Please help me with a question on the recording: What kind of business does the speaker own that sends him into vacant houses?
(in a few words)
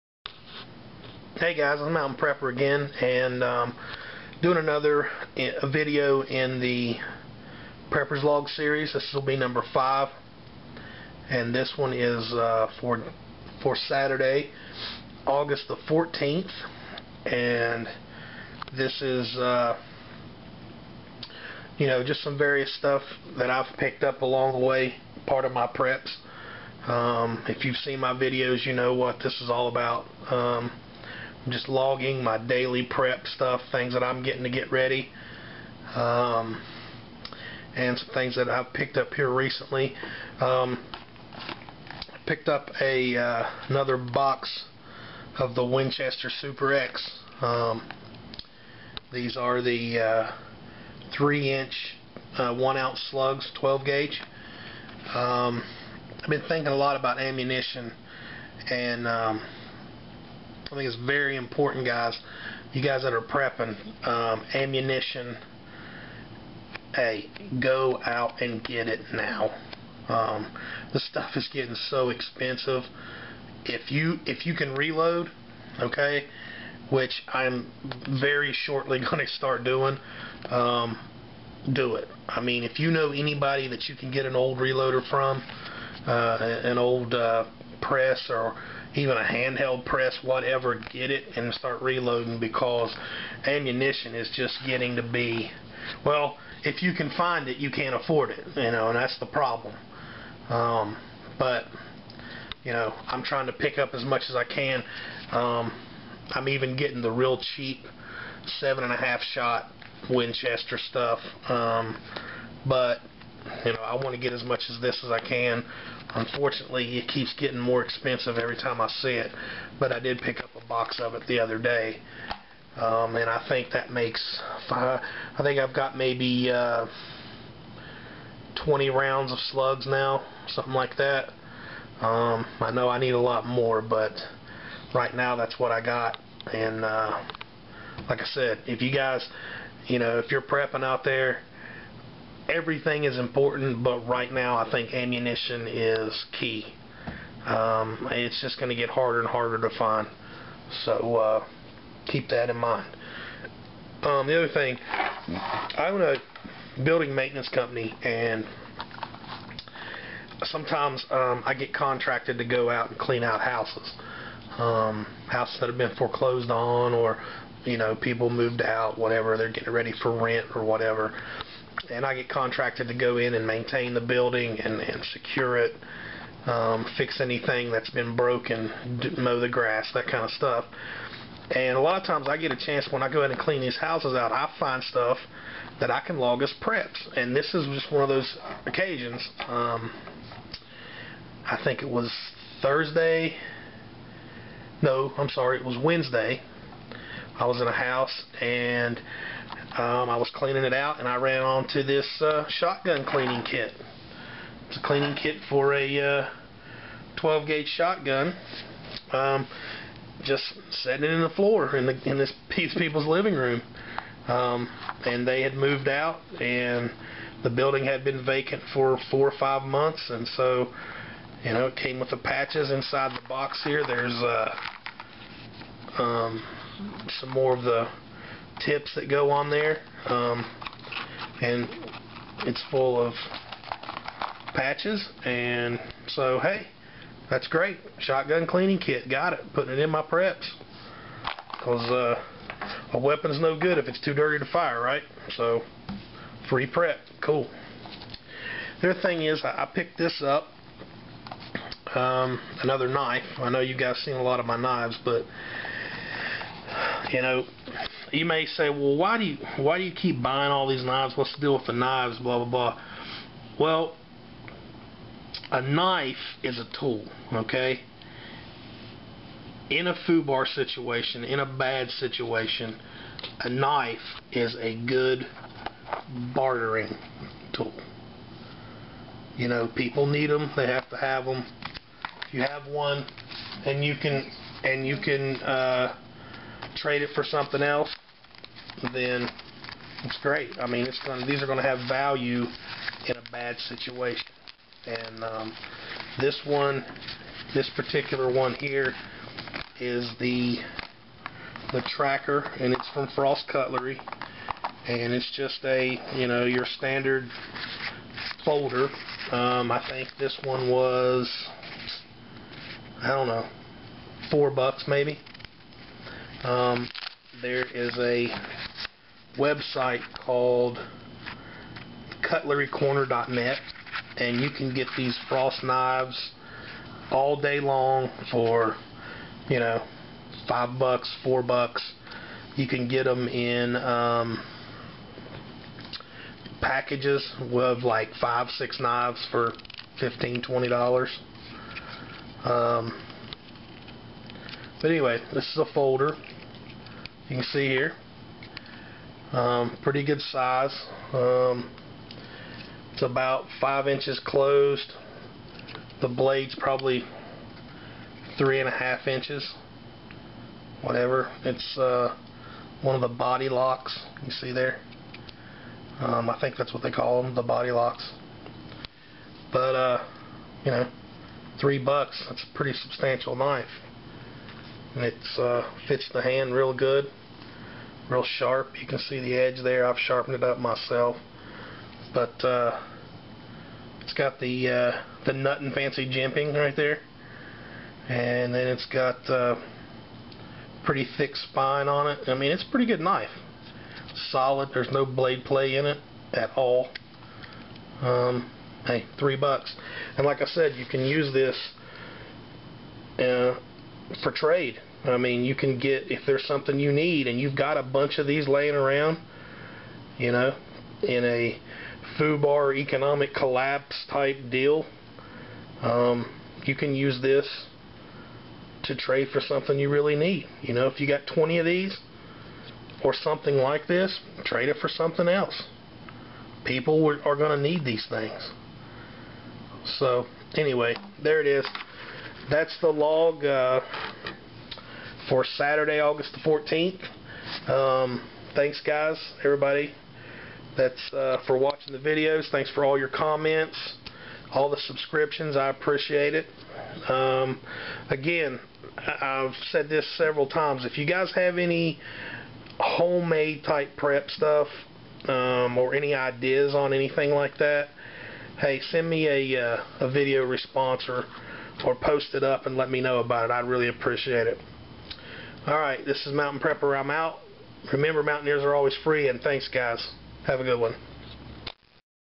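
building maintenance company.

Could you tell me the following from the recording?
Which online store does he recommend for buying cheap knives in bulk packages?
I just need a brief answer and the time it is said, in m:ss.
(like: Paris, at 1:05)
cutlerycorner.net, at 5:22.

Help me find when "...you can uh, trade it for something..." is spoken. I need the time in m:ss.
4:44.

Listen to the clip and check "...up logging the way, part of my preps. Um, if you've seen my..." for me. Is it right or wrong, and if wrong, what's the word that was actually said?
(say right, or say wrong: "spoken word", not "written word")
wrong: "along", not "logging".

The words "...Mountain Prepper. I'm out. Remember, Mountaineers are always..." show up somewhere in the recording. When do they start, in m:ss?
7:46.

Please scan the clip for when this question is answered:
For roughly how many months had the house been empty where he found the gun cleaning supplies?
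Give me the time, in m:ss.
3:39.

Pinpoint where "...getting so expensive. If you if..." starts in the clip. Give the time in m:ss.
1:11.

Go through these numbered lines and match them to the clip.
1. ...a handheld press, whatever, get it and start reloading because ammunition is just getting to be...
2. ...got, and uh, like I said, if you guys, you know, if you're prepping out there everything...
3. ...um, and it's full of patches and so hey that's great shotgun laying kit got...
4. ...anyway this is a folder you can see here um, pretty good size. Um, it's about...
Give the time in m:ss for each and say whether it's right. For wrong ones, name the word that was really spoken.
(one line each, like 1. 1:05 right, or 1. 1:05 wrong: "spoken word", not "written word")
1. 1:29 right
2. 2:15 right
3. 3:50 wrong: "cleaning", not "laying"
4. 5:44 right.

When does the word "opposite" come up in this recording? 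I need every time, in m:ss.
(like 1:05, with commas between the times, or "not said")
not said.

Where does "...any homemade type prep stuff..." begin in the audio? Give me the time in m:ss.
7:31.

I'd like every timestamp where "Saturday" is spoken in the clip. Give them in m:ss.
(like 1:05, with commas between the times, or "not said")
0:13, 7:15.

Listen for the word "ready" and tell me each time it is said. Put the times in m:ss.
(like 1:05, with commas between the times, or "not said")
0:34, 2:49.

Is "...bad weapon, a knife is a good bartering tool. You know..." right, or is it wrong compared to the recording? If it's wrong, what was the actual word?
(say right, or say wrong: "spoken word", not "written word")
wrong: "situation", not "weapon".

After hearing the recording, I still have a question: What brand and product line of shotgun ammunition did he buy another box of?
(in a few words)
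Winchester Super X.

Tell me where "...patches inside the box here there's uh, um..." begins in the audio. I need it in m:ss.
3:42.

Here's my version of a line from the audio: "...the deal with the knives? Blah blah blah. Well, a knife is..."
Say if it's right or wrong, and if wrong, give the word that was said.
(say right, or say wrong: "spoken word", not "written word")
right.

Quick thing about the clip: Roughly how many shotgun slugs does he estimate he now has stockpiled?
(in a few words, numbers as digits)
20.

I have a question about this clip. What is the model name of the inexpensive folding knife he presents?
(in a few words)
the tracker.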